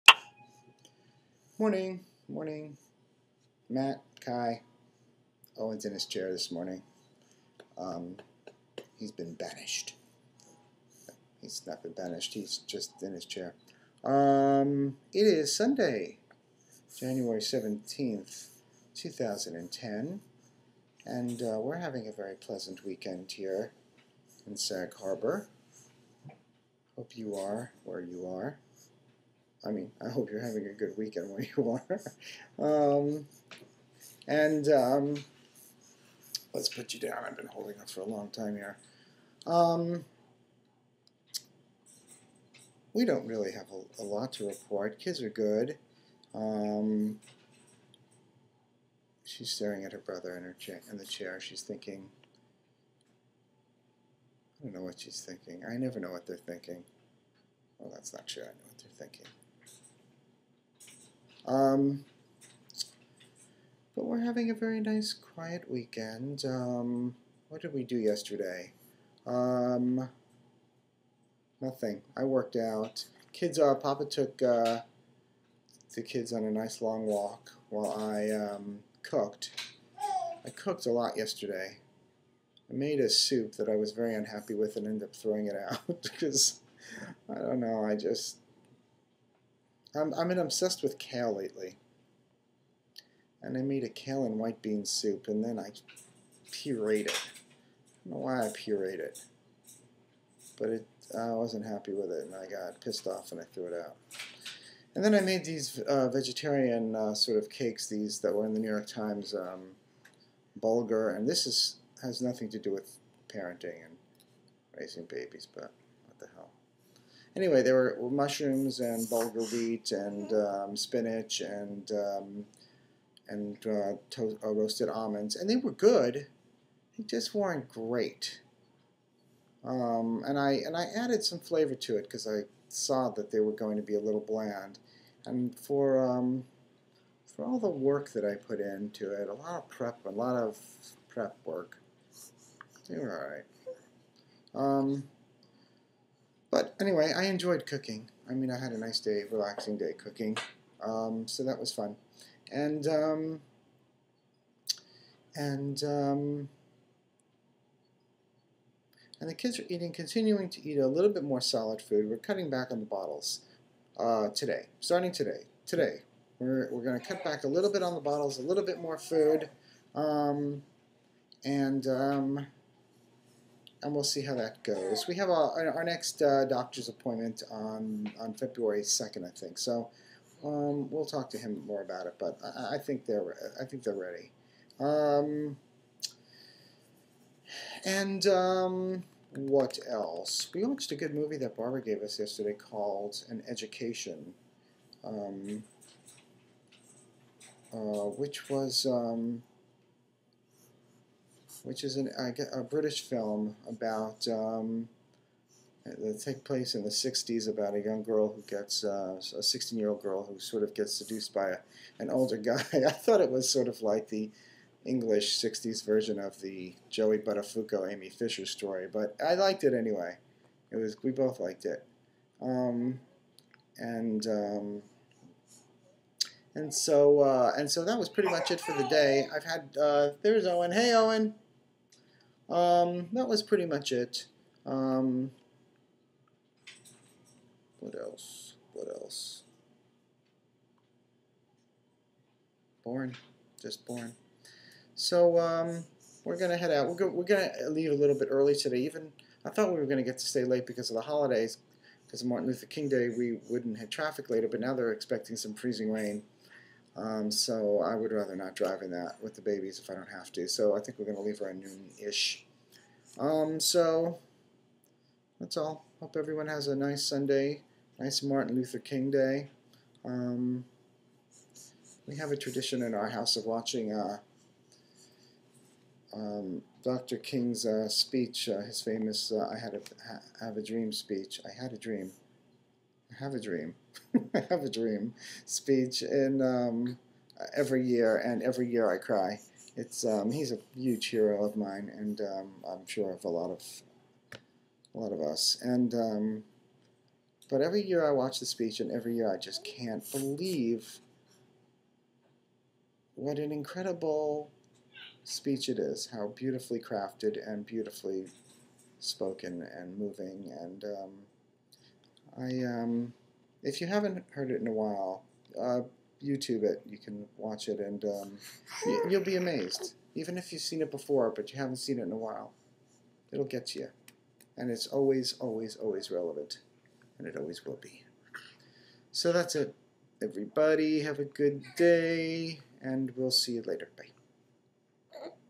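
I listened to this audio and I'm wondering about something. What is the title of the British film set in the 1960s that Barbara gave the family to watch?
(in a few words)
An Education.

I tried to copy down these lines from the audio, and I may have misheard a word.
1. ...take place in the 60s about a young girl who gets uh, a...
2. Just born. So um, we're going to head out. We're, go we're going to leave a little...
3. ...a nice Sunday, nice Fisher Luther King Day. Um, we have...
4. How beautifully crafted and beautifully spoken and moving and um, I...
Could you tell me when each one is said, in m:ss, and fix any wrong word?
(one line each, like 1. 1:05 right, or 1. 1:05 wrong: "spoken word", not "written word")
1. 3:26 right
2. 4:03 right
3. 4:26 wrong: "Martin", not "Fisher"
4. 5:06 right.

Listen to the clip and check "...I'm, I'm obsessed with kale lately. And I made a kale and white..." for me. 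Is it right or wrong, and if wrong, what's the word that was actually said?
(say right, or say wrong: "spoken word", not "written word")
right.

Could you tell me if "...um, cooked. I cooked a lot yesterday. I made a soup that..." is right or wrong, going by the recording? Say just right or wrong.
right.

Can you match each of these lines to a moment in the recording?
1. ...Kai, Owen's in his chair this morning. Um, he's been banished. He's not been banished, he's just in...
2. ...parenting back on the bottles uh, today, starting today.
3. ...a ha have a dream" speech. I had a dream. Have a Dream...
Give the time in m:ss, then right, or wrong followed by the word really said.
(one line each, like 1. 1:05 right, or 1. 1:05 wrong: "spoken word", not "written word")
1. 0:04 right
2. 2:42 wrong: "cutting", not "parenting"
3. 4:39 right.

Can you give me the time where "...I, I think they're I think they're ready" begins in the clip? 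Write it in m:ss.
3:02.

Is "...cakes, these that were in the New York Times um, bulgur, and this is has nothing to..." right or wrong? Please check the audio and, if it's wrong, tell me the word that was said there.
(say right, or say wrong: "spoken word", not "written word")
right.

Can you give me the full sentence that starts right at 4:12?
Because of Martin Luther King Day, we wouldn't hit traffic later, but now they're expecting some freezing rain.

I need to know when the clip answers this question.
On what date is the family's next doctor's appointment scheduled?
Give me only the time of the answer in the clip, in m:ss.
2:58.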